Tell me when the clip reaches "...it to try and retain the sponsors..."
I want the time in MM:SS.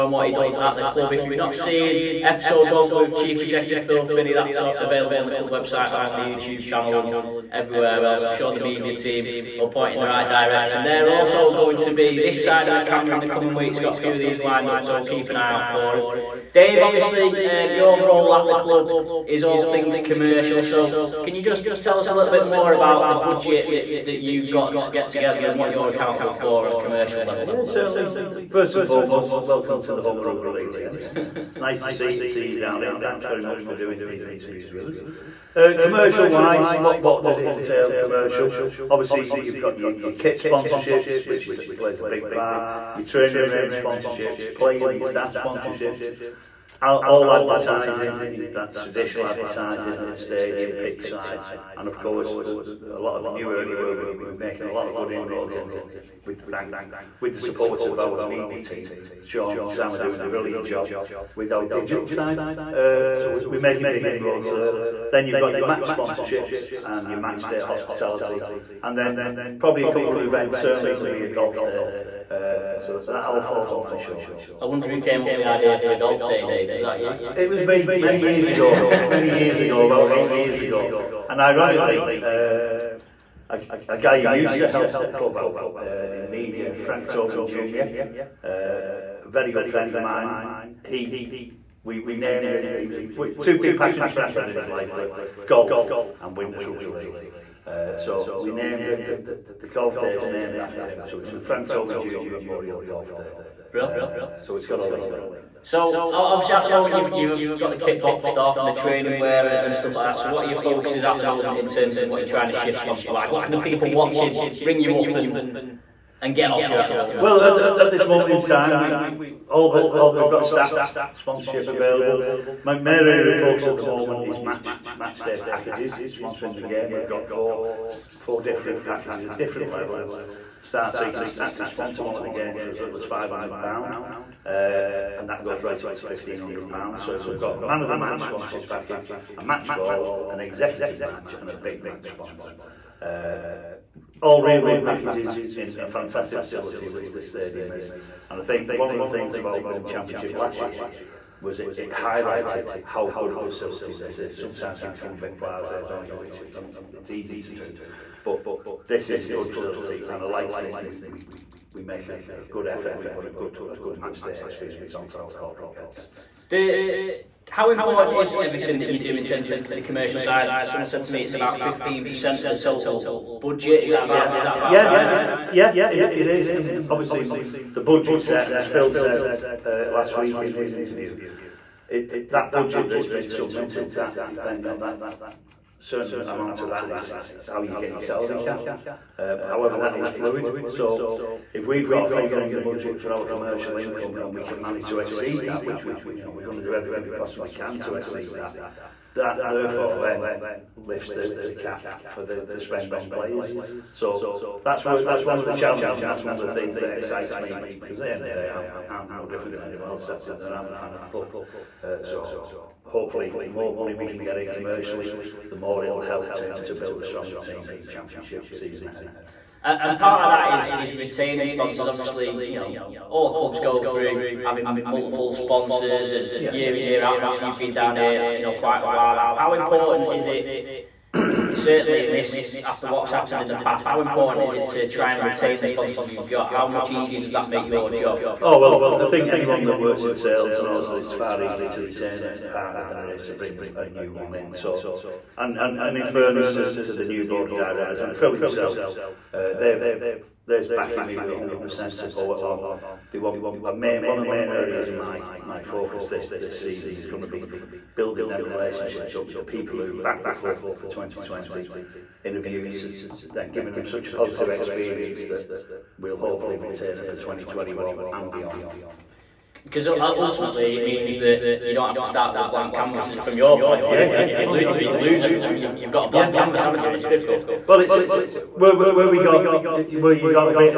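03:54.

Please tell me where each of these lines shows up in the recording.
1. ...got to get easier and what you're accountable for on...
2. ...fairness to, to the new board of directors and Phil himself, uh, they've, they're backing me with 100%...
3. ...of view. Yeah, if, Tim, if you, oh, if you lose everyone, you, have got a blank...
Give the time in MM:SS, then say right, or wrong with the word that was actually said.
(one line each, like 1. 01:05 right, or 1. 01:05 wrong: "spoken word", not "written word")
1. 00:24 wrong: "together", not "easier"
2. 04:06 right
3. 04:33 wrong: "You", not "Tim".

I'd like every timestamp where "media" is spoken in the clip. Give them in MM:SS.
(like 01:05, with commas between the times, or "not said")
00:08, 00:58, 01:26.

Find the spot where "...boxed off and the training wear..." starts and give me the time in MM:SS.
01:48.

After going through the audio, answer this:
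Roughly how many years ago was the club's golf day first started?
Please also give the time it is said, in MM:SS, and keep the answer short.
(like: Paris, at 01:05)
about 8 years ago, at 01:19.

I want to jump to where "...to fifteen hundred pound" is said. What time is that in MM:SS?
02:15.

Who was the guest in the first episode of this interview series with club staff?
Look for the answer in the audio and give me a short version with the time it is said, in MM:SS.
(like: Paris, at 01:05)
Phil Finney, at 00:03.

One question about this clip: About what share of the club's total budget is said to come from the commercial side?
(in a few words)
15%.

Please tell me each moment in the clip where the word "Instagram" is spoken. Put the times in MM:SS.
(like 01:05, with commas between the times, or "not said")
not said.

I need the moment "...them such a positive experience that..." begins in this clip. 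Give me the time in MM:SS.
04:23.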